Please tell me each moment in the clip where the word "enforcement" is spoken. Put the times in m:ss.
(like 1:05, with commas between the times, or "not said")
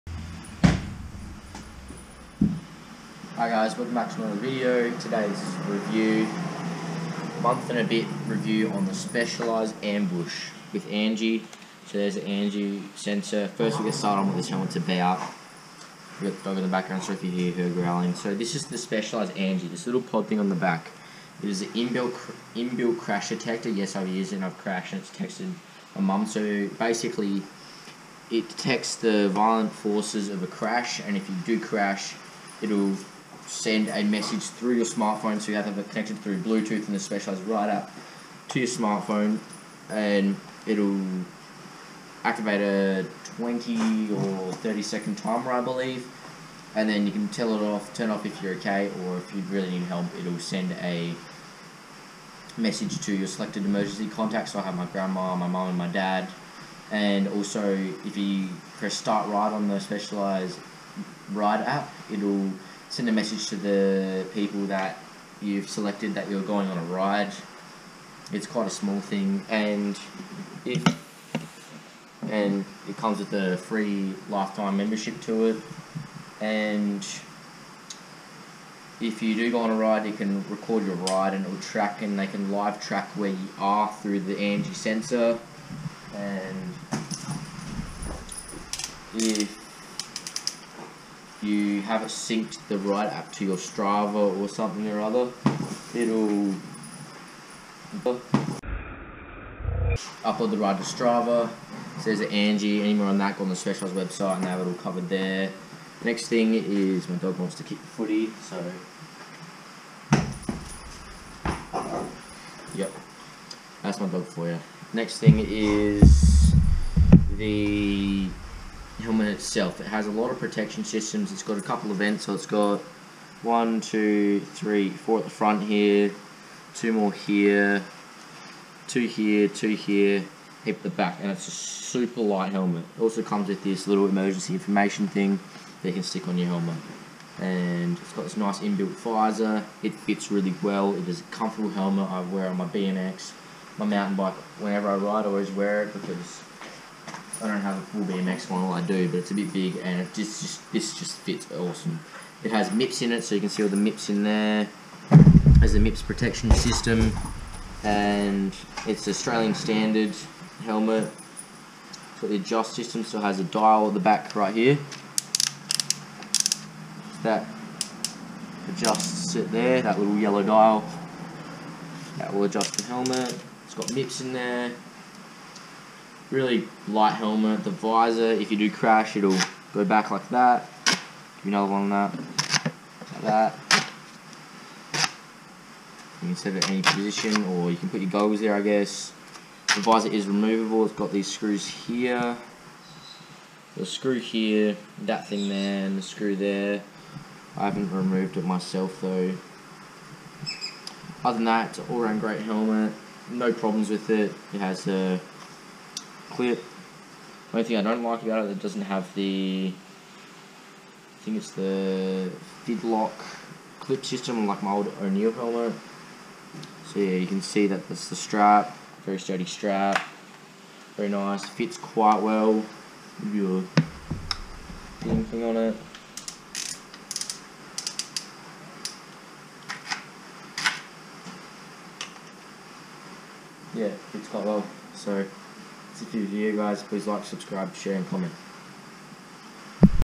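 not said.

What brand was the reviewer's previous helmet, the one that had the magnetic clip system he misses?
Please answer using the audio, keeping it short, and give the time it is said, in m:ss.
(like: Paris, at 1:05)
O'Neal, at 3:35.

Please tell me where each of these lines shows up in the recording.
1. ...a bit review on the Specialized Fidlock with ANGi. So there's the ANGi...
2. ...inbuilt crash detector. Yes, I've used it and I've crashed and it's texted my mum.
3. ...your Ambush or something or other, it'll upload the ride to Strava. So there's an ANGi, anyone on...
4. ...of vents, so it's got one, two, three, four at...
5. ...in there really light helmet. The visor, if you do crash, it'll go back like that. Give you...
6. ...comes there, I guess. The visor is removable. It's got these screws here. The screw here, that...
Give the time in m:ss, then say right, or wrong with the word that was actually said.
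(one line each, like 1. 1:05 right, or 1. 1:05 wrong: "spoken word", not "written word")
1. 0:07 wrong: "Ambush", not "Fidlock"
2. 0:22 right
3. 1:33 wrong: "Strava", not "Ambush"
4. 2:01 right
5. 2:54 right
6. 3:08 wrong: "goggles", not "comes".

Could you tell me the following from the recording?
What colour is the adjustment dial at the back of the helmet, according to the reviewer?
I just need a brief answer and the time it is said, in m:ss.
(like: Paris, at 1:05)
Yellow, at 2:50.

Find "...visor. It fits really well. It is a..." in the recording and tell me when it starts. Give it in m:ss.
2:19.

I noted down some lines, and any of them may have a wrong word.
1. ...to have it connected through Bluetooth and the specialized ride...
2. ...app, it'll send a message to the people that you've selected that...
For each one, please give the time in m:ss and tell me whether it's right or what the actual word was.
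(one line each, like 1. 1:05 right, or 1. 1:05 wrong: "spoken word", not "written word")
1. 0:35 right
2. 1:01 right.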